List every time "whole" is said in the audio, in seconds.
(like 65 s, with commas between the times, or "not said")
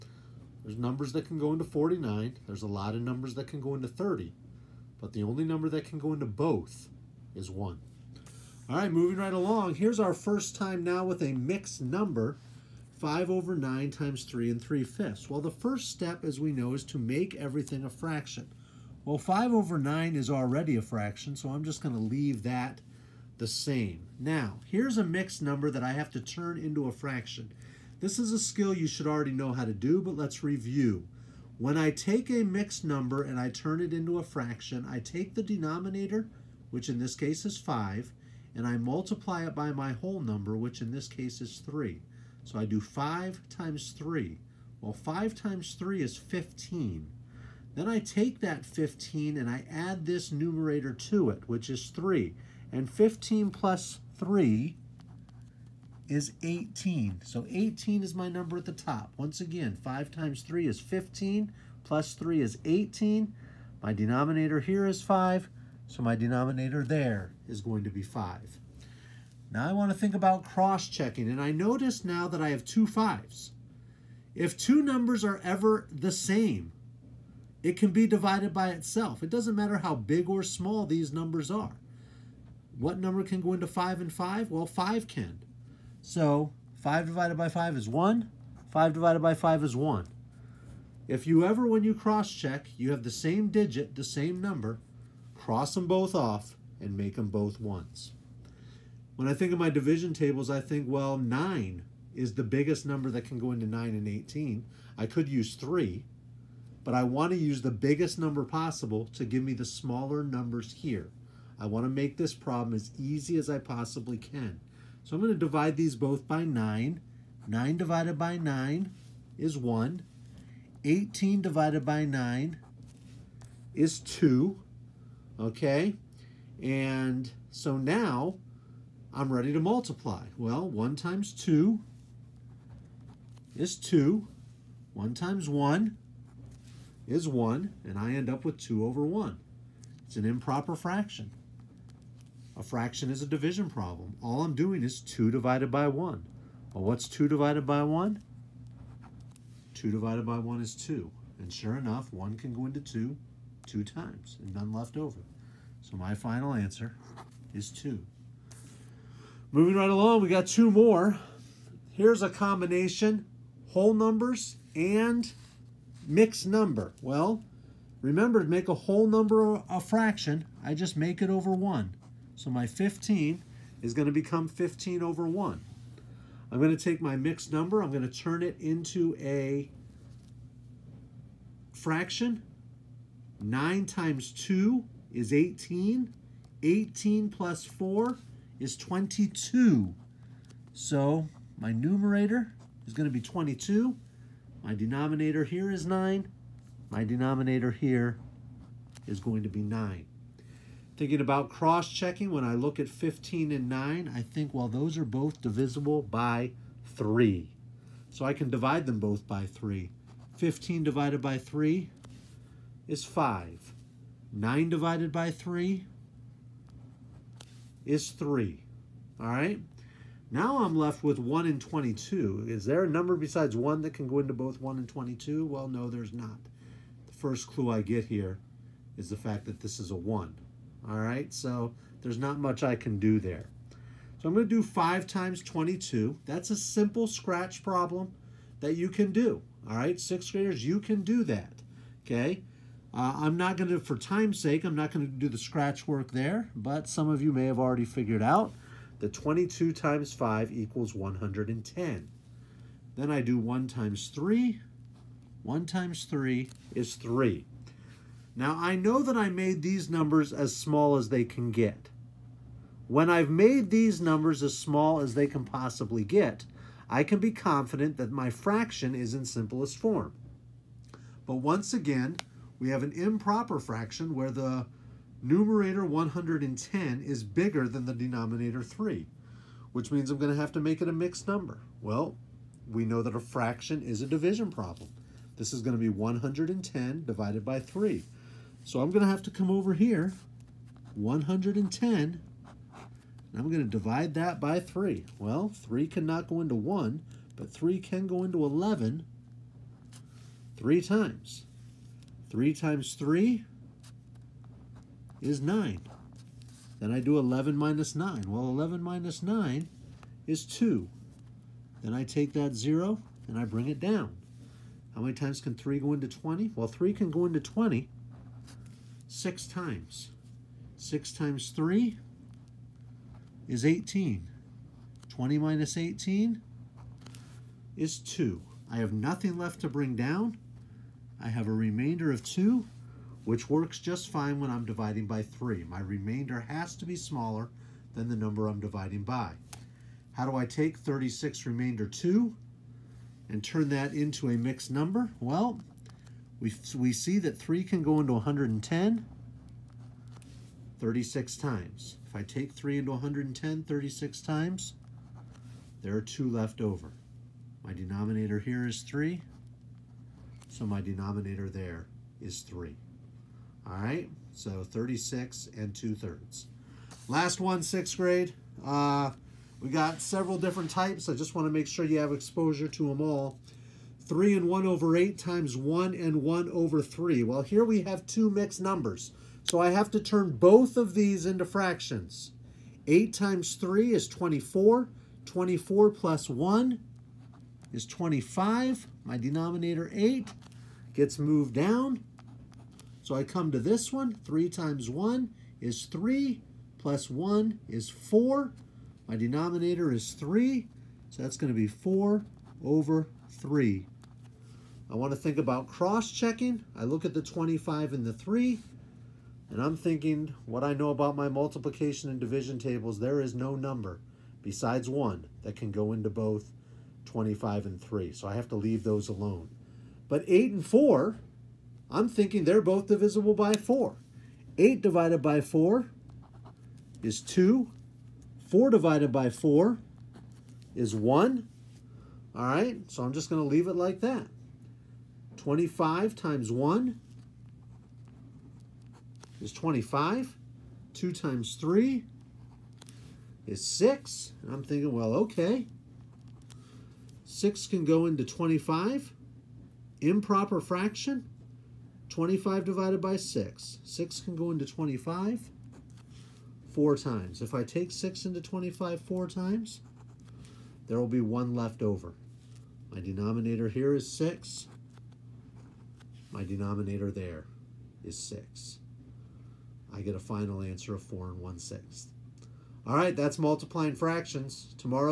39 s, 163 s, 168 s.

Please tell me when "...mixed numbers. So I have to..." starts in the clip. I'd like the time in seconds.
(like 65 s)
378 s.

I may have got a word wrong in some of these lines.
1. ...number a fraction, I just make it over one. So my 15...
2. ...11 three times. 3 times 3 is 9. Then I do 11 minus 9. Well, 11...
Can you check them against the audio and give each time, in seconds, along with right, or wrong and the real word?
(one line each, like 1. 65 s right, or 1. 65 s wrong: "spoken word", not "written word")
1. 169 s right
2. 298 s right.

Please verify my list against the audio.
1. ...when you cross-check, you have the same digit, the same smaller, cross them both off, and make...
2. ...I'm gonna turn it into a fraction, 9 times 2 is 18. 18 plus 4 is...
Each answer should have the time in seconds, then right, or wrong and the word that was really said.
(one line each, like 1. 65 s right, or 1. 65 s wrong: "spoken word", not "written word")
1. 91 s wrong: "number", not "smaller"
2. 177 s right.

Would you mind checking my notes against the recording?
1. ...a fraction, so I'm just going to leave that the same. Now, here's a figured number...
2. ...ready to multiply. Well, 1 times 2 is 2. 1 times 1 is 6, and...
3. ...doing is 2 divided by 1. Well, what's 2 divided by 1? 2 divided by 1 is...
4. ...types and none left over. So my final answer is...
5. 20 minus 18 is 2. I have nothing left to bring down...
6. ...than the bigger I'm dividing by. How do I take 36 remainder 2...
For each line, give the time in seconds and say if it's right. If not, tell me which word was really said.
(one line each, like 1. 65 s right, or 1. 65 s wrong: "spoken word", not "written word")
1. 20 s wrong: "mixed", not "figured"
2. 129 s wrong: "1", not "6"
3. 144 s right
4. 153 s wrong: "times", not "types"
5. 325 s right
6. 337 s wrong: "number", not "bigger".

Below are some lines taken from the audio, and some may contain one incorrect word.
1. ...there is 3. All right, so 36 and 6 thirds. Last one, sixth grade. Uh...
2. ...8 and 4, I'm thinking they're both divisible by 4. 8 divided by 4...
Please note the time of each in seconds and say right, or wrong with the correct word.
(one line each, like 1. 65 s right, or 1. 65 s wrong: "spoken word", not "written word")
1. 361 s wrong: "2", not "6"
2. 420 s right.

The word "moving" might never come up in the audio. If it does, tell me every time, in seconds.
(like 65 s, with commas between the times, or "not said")
8 s, 159 s.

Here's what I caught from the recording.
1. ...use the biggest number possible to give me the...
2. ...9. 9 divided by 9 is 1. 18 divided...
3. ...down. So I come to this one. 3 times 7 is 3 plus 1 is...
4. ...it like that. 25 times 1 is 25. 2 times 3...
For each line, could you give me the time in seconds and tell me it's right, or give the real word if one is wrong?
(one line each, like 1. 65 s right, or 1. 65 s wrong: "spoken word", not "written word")
1. 107 s right
2. 116 s right
3. 391 s wrong: "1", not "7"
4. 433 s right.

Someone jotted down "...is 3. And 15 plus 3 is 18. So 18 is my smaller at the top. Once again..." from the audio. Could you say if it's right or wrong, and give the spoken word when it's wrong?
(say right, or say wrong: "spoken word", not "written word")
wrong: "number", not "smaller".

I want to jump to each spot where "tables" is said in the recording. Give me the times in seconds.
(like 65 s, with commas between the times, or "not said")
100 s, 412 s.